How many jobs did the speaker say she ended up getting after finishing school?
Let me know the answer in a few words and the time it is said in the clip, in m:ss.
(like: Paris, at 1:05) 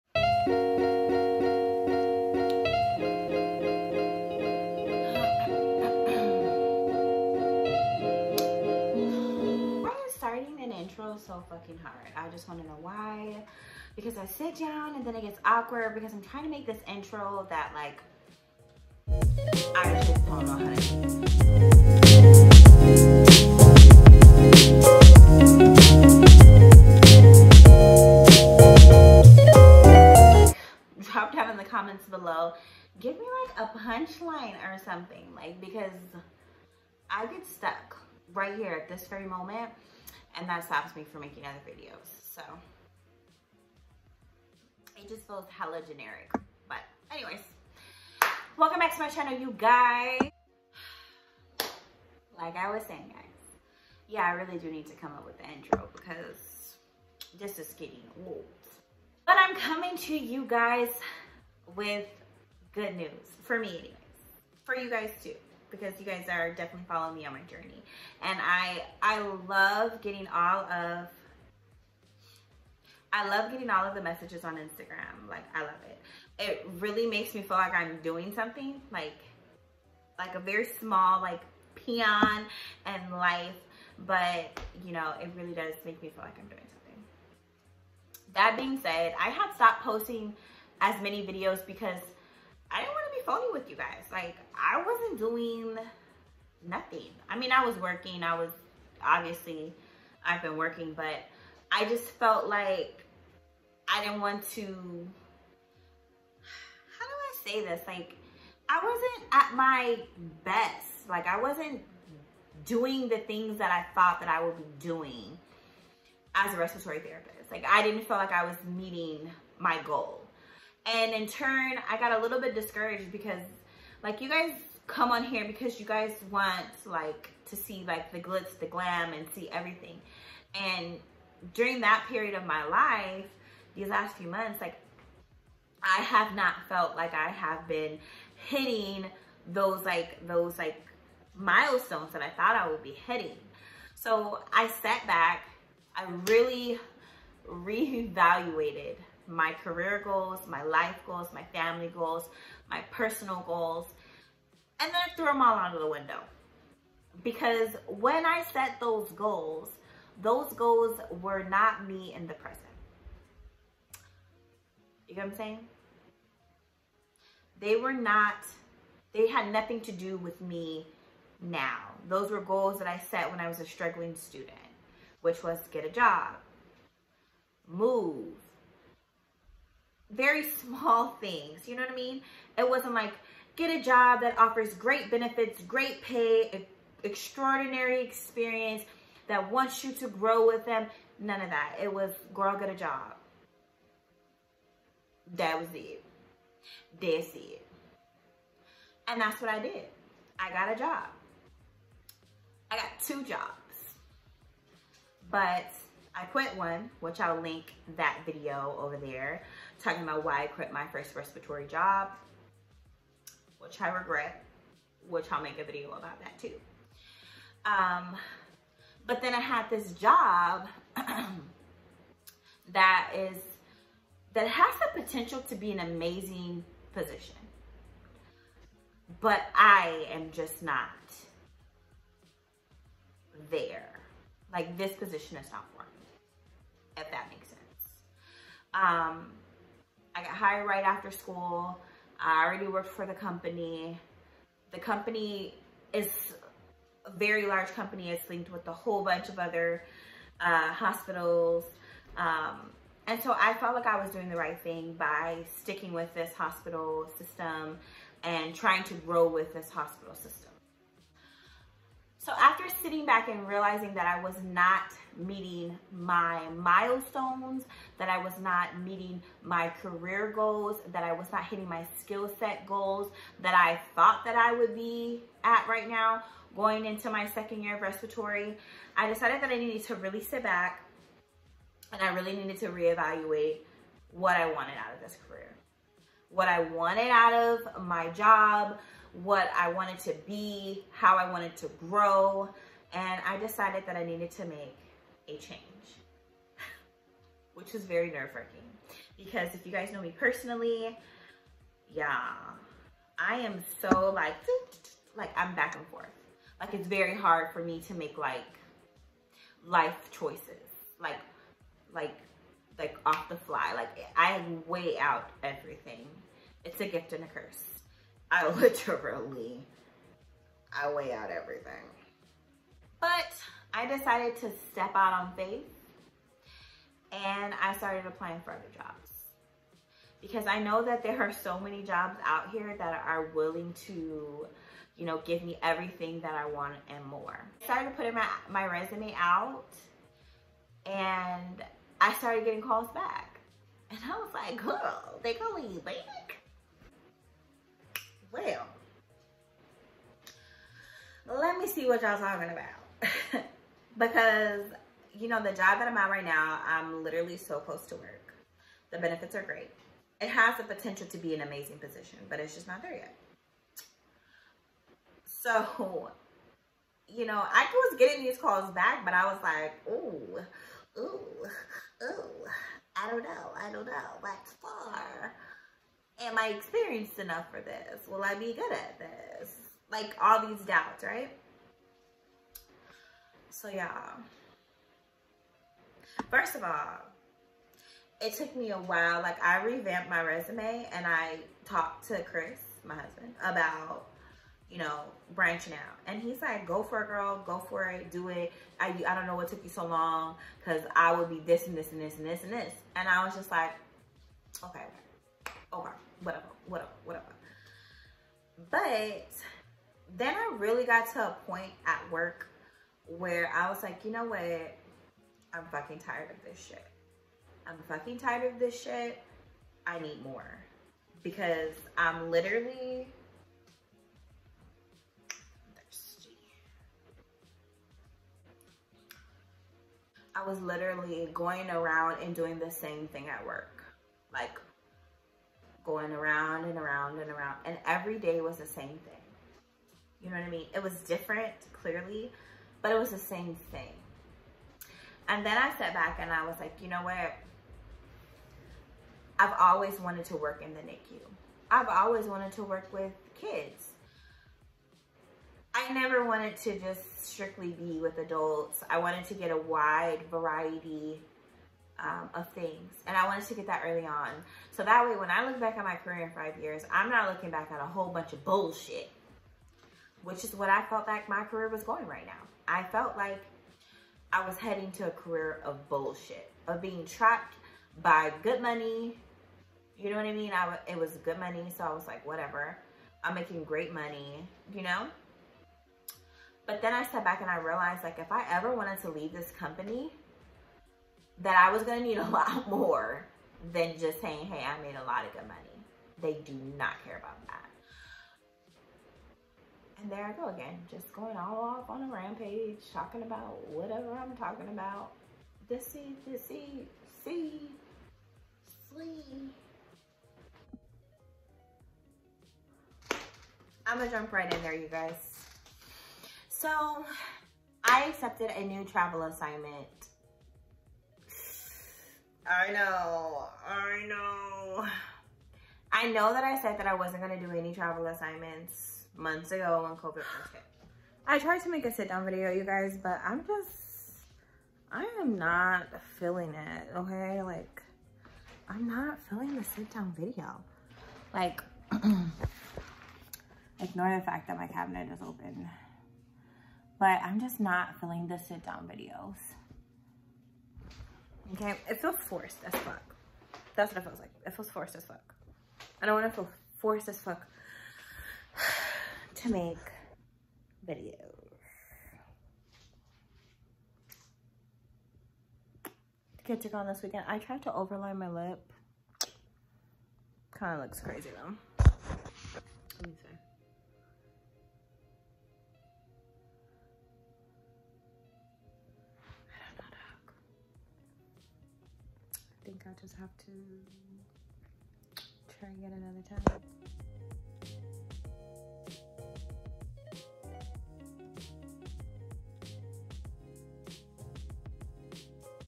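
2, at 3:23.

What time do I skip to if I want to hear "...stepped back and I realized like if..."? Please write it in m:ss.
8:07.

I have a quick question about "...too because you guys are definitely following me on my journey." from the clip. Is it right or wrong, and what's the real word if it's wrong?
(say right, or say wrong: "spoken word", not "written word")
right.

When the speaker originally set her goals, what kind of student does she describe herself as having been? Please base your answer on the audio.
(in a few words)
A struggling student.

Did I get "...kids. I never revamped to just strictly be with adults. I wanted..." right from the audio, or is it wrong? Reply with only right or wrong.
wrong.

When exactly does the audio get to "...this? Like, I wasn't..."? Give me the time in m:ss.
1:47.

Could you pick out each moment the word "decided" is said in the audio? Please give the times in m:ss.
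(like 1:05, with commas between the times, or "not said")
4:39, 4:53, 5:23.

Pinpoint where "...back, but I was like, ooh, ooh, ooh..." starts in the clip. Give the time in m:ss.
6:08.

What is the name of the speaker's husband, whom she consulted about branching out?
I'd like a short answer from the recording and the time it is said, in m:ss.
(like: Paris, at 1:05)
Chris, at 6:32.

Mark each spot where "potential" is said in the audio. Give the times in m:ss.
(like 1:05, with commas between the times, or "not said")
3:45, 6:00.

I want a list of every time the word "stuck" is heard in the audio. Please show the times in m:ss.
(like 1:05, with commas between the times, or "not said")
0:37.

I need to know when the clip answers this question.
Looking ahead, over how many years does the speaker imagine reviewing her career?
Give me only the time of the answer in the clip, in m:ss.
7:46.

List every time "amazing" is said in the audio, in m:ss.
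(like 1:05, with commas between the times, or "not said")
3:45, 6:01.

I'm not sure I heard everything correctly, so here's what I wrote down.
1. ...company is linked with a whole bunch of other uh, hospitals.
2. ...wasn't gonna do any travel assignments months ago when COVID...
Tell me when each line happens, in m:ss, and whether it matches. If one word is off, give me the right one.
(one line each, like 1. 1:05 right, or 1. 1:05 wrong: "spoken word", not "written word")
1. 4:07 right
2. 8:46 right.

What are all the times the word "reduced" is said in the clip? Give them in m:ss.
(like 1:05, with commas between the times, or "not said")
not said.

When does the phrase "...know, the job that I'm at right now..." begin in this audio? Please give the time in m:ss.
5:55.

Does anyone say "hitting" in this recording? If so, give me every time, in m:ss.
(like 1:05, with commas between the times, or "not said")
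2:18, 2:23, 4:31.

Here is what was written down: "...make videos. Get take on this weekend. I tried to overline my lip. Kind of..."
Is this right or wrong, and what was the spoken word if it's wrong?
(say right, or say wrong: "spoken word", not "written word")
right.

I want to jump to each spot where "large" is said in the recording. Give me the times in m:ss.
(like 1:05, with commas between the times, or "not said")
4:07.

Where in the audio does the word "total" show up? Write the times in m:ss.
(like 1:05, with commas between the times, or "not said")
not said.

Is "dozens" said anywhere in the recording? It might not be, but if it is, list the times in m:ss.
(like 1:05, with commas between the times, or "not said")
not said.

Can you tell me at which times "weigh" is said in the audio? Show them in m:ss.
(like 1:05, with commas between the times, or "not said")
5:14, 5:20.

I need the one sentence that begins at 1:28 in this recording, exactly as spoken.
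That being said, I have stopped posting as many videos because I didn't want to be phony with you guys.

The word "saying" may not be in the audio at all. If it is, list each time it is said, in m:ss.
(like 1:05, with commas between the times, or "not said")
0:52, 2:45, 8:14.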